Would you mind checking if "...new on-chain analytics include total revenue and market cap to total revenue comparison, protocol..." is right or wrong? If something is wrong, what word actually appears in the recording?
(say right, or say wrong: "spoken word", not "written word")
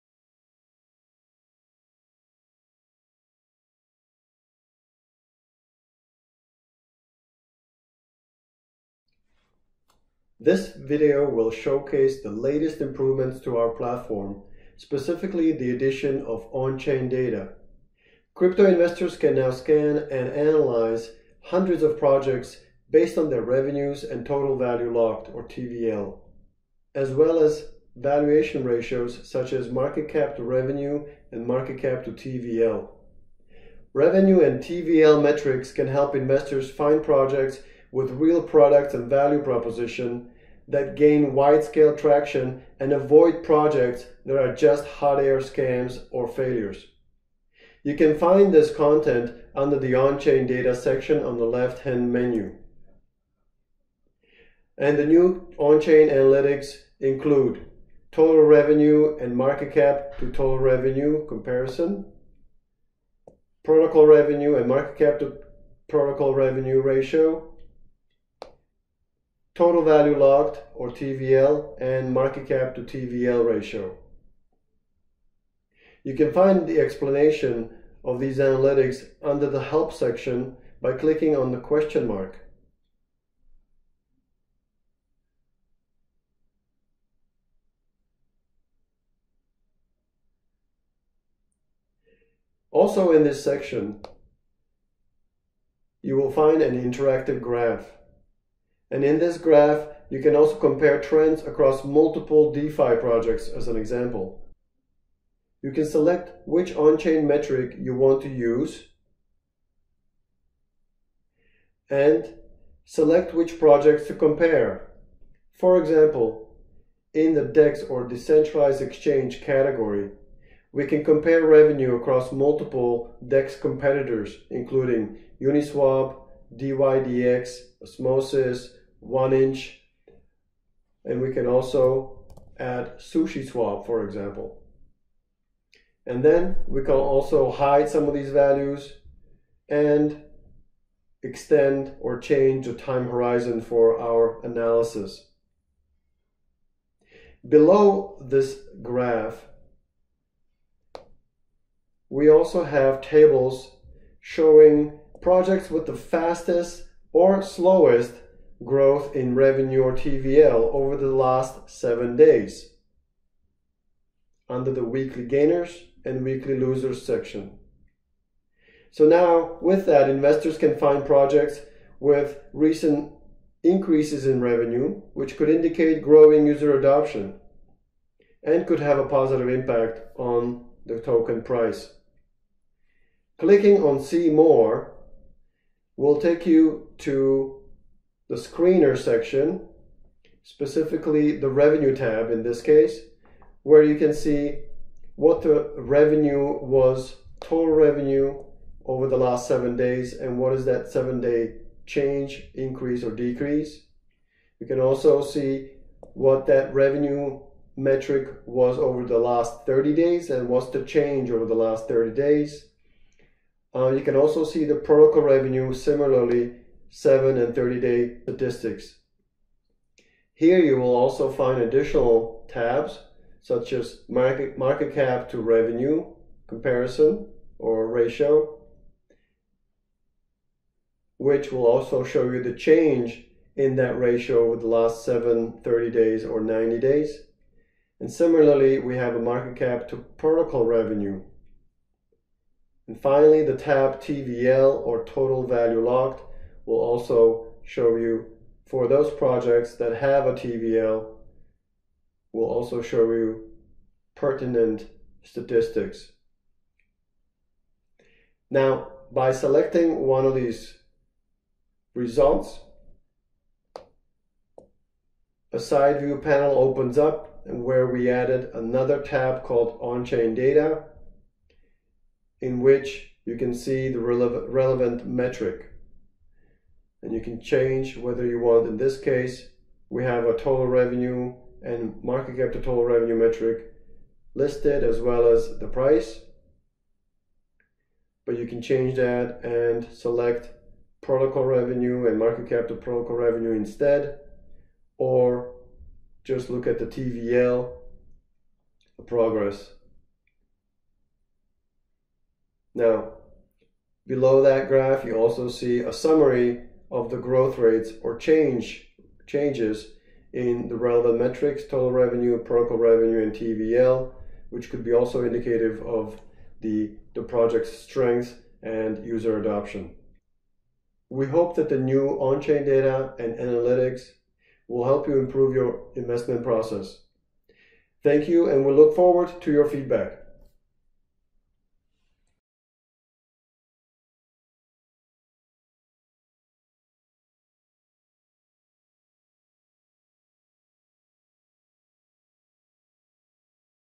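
right.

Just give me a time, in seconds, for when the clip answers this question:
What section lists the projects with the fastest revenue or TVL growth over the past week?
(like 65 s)
164 s.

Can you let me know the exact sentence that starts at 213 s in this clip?
Uh, you can also see the protocol revenue similarly 7, and 30-day statistics.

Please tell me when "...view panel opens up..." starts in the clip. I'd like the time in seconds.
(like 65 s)
265 s.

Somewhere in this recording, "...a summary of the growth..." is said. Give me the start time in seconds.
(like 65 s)
305 s.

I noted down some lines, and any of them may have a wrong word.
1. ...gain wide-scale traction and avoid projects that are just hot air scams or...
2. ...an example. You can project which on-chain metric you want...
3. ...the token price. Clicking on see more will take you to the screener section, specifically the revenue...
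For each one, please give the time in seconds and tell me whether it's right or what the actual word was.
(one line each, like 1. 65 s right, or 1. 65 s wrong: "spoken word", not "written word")
1. 40 s right
2. 103 s wrong: "select", not "project"
3. 180 s right.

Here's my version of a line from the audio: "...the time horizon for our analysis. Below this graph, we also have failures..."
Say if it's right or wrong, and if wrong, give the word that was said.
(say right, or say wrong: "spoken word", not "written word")
wrong: "tables", not "failures".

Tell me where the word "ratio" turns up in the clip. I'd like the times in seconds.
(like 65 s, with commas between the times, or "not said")
28 s, 66 s, 73 s, 227 s, 233 s.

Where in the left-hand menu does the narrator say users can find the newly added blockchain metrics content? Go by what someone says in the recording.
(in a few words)
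On-chain data section.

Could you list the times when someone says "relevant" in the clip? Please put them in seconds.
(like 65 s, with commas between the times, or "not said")
273 s, 310 s.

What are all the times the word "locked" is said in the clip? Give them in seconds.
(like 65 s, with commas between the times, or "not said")
24 s, 70 s, 245 s.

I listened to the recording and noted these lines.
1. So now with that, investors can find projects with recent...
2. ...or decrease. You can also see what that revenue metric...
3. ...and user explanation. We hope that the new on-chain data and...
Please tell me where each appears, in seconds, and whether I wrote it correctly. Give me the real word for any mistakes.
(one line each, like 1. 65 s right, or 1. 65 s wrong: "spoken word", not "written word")
1. 168 s right
2. 203 s right
3. 318 s wrong: "adoption", not "explanation".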